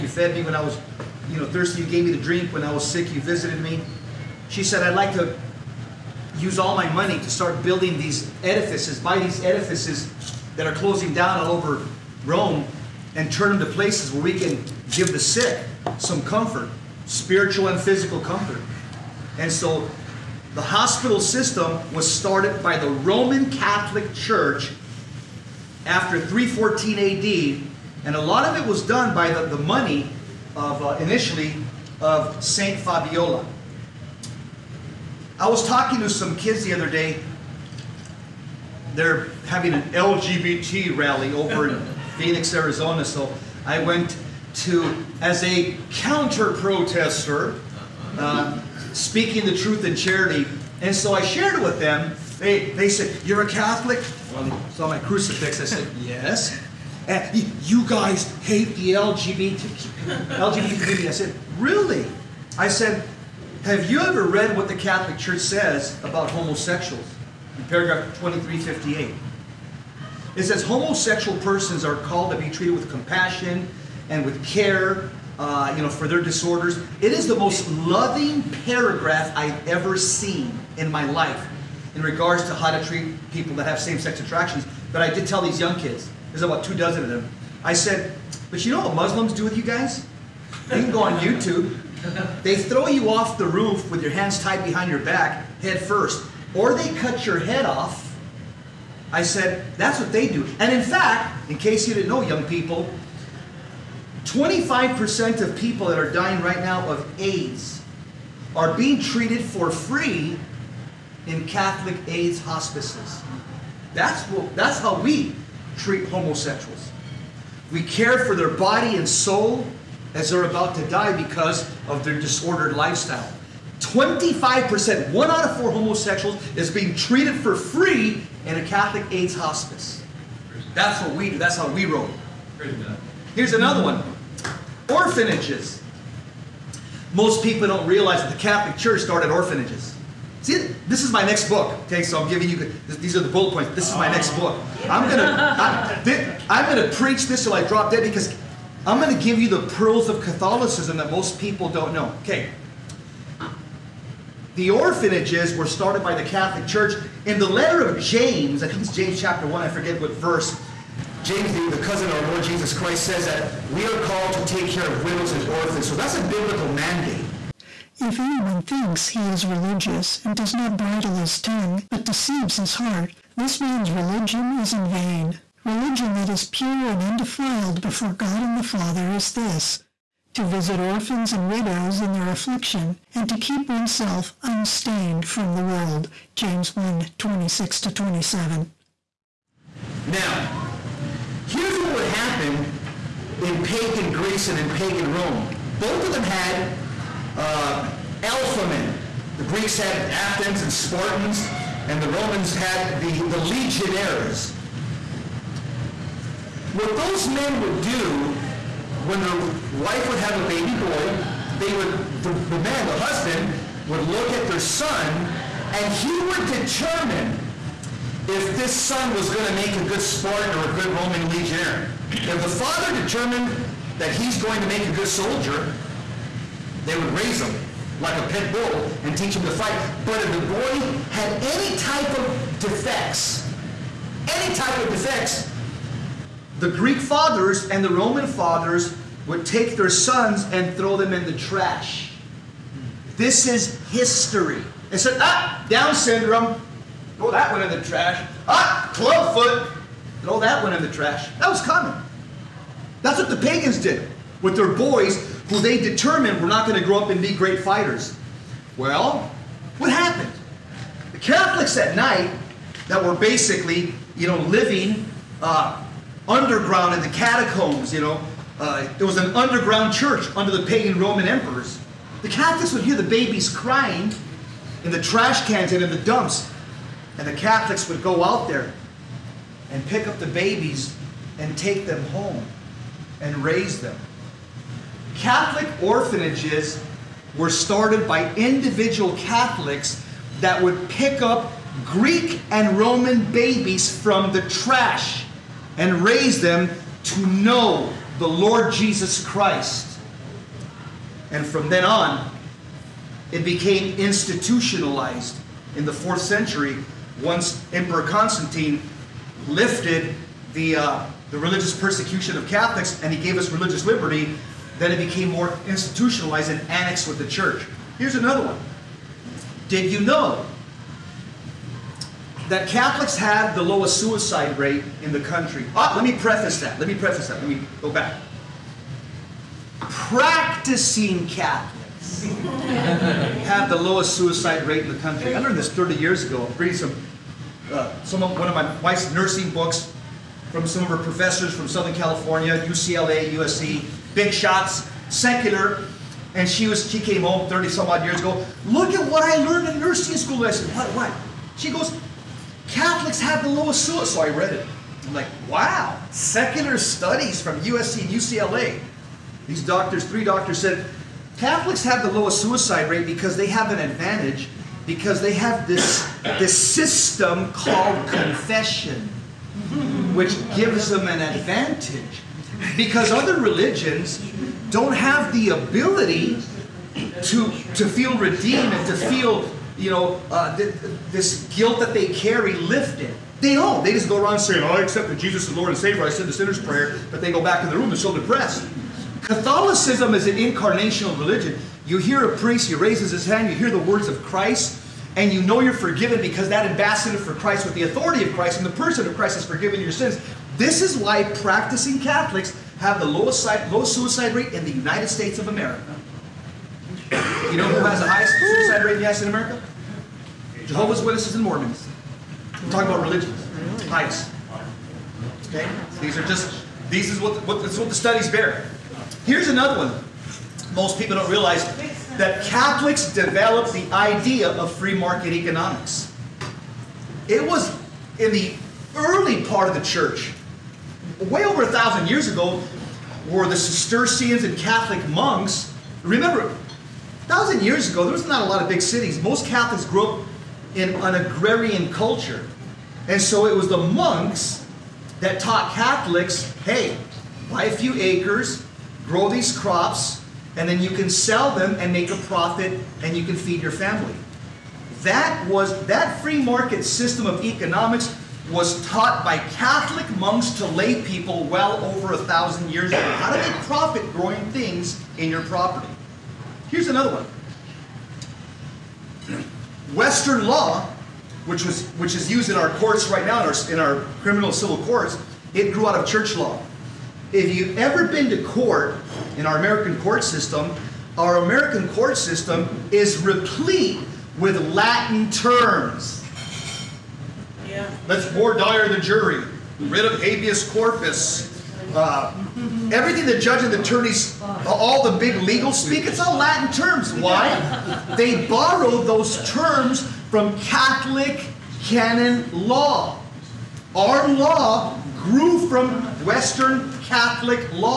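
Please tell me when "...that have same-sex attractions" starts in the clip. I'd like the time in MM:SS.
01:23.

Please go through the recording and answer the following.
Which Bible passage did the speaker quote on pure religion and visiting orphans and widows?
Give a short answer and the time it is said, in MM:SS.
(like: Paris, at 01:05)
James 1:26-27, at 03:06.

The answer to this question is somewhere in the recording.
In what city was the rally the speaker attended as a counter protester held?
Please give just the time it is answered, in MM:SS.
00:42.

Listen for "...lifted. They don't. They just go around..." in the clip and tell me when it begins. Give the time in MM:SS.
06:22.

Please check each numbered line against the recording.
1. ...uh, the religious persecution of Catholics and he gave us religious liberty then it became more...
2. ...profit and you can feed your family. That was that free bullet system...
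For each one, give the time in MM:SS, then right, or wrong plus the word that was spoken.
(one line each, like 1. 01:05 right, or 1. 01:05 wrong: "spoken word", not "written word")
1. 05:10 right
2. 07:32 wrong: "market", not "bullet".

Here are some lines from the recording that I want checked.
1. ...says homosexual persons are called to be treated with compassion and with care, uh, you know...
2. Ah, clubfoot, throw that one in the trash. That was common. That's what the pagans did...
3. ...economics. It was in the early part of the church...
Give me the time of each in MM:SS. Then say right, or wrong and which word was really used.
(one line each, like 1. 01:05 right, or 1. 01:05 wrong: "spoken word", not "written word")
1. 01:10 right
2. 04:08 right
3. 07:05 right.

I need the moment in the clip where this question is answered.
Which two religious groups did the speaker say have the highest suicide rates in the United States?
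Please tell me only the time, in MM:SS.
06:50.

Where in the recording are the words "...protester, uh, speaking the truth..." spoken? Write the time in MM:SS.
00:46.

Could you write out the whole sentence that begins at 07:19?
Most Catholics grew up in an agrarian culture.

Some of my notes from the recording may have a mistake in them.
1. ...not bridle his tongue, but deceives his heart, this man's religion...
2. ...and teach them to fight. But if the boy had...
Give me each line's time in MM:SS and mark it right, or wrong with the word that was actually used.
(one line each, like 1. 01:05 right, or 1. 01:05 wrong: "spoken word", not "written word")
1. 02:50 right
2. 03:49 right.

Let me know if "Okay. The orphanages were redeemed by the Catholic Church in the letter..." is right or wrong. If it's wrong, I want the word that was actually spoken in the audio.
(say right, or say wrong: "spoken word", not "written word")
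wrong: "started", not "redeemed".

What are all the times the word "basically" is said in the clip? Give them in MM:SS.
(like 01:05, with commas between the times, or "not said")
04:23.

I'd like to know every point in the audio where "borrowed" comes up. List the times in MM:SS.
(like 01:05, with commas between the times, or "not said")
08:18.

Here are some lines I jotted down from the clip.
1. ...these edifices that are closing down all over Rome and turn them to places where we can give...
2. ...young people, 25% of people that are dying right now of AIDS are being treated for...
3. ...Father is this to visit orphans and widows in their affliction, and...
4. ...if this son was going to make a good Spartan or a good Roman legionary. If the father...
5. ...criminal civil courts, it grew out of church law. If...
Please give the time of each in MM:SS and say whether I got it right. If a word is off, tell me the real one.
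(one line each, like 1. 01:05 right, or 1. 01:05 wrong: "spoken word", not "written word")
1. 00:09 right
2. 01:42 right
3. 02:58 right
4. 03:38 right
5. 07:54 right.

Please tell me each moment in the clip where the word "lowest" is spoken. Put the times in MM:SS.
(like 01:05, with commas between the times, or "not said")
05:23, 05:33, 05:53, 06:02, 06:43.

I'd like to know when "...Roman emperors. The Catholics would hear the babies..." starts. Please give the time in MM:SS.
04:31.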